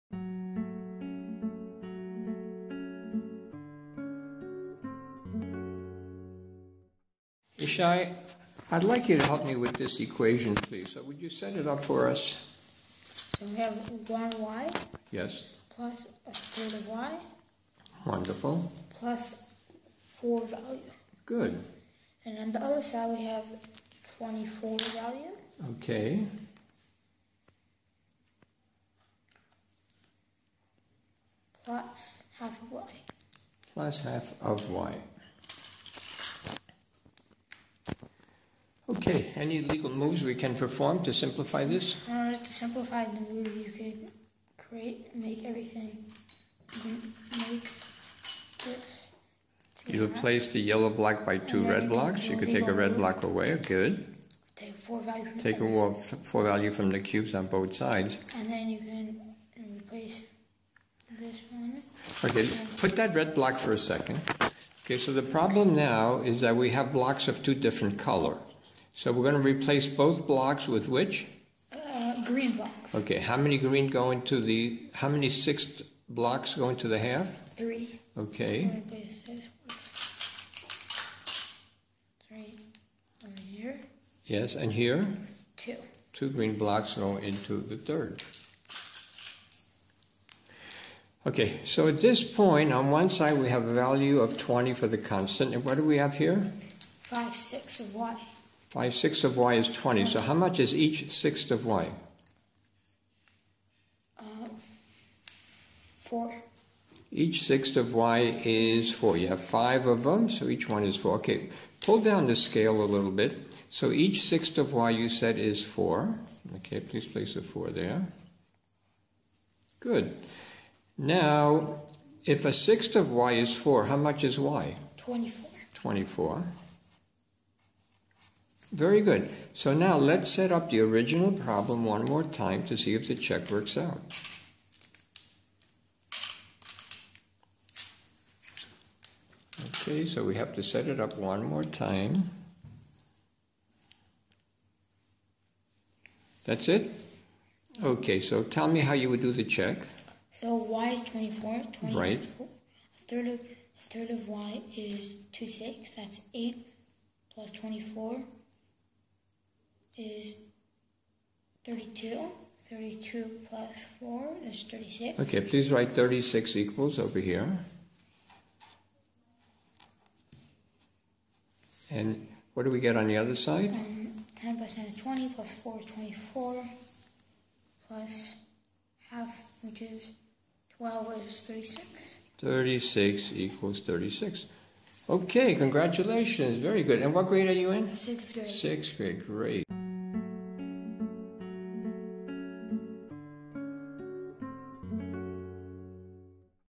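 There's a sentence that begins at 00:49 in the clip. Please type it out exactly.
You replace the yellow block by two red blocks.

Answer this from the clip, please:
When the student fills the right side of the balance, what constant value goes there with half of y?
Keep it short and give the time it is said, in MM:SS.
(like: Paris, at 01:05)
24, at 00:24.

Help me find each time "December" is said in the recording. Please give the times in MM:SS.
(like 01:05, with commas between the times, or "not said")
not said.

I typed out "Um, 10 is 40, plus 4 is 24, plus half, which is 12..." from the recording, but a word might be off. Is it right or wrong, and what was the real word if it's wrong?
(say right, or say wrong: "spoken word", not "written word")
wrong: "20", not "40".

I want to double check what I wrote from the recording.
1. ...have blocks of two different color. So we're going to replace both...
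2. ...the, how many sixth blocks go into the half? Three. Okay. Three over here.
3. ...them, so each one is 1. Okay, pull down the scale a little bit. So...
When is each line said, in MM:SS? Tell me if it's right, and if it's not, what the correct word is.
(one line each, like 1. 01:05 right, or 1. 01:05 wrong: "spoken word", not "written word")
1. 01:06 right
2. 01:14 right
3. 01:50 wrong: "4", not "1".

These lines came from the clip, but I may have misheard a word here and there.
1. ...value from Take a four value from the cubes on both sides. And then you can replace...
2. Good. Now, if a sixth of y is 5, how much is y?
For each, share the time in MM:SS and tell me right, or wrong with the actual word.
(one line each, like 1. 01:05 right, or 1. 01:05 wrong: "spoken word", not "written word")
1. 00:54 right
2. 01:59 wrong: "4", not "5".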